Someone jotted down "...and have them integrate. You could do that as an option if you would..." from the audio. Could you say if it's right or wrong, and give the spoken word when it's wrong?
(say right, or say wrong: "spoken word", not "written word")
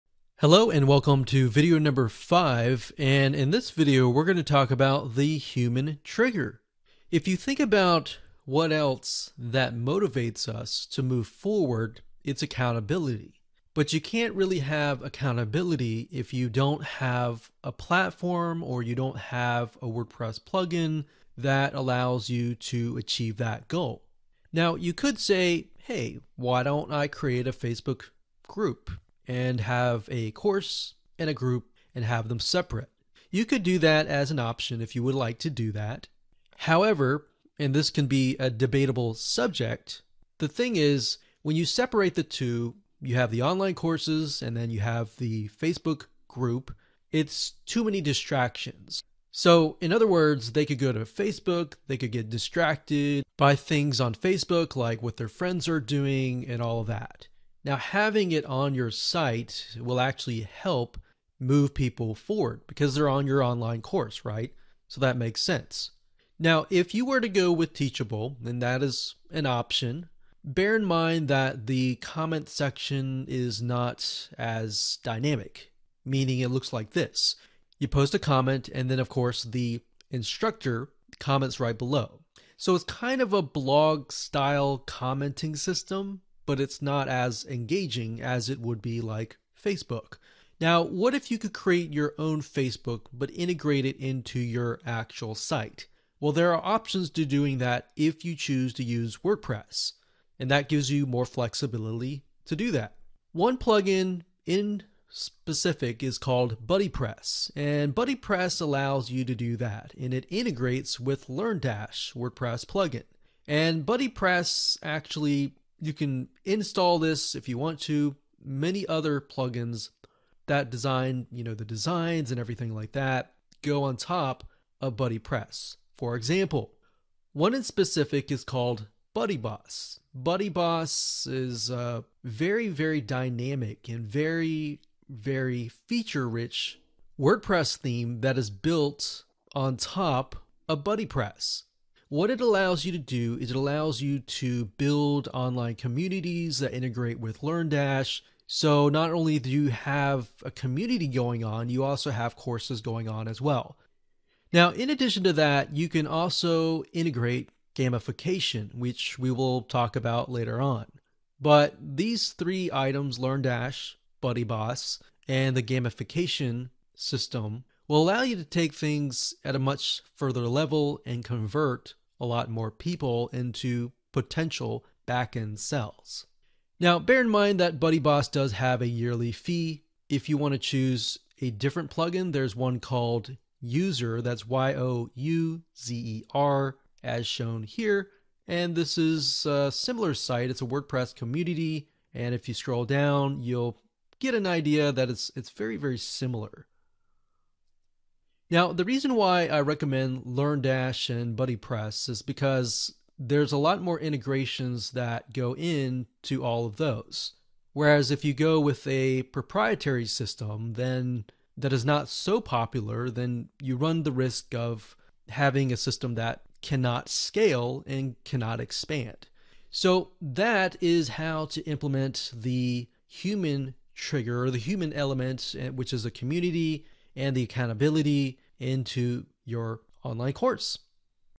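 wrong: "separate", not "integrate".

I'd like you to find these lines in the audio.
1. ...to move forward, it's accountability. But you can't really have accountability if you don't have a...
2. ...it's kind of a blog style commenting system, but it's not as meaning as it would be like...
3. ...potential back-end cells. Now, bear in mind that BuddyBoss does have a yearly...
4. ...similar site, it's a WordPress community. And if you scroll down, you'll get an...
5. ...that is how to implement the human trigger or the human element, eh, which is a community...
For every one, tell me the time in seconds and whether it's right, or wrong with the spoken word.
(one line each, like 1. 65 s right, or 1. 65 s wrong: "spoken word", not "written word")
1. 10 s right
2. 82 s wrong: "engaging", not "meaning"
3. 174 s right
4. 189 s right
5. 220 s right.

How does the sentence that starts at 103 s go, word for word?
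One plugin in specific is called BuddyPress, and BuddyPress allows you to do that, and it integrates with LearnDash WordPress plugin.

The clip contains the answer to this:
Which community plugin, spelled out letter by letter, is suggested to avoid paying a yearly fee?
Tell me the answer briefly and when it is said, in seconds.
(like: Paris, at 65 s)
Youzer, at 183 s.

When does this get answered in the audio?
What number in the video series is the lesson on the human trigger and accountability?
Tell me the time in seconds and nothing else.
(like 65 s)
2 s.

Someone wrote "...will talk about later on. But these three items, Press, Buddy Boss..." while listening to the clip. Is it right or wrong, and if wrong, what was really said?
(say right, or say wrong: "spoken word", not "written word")
wrong: "LearnDash", not "Press".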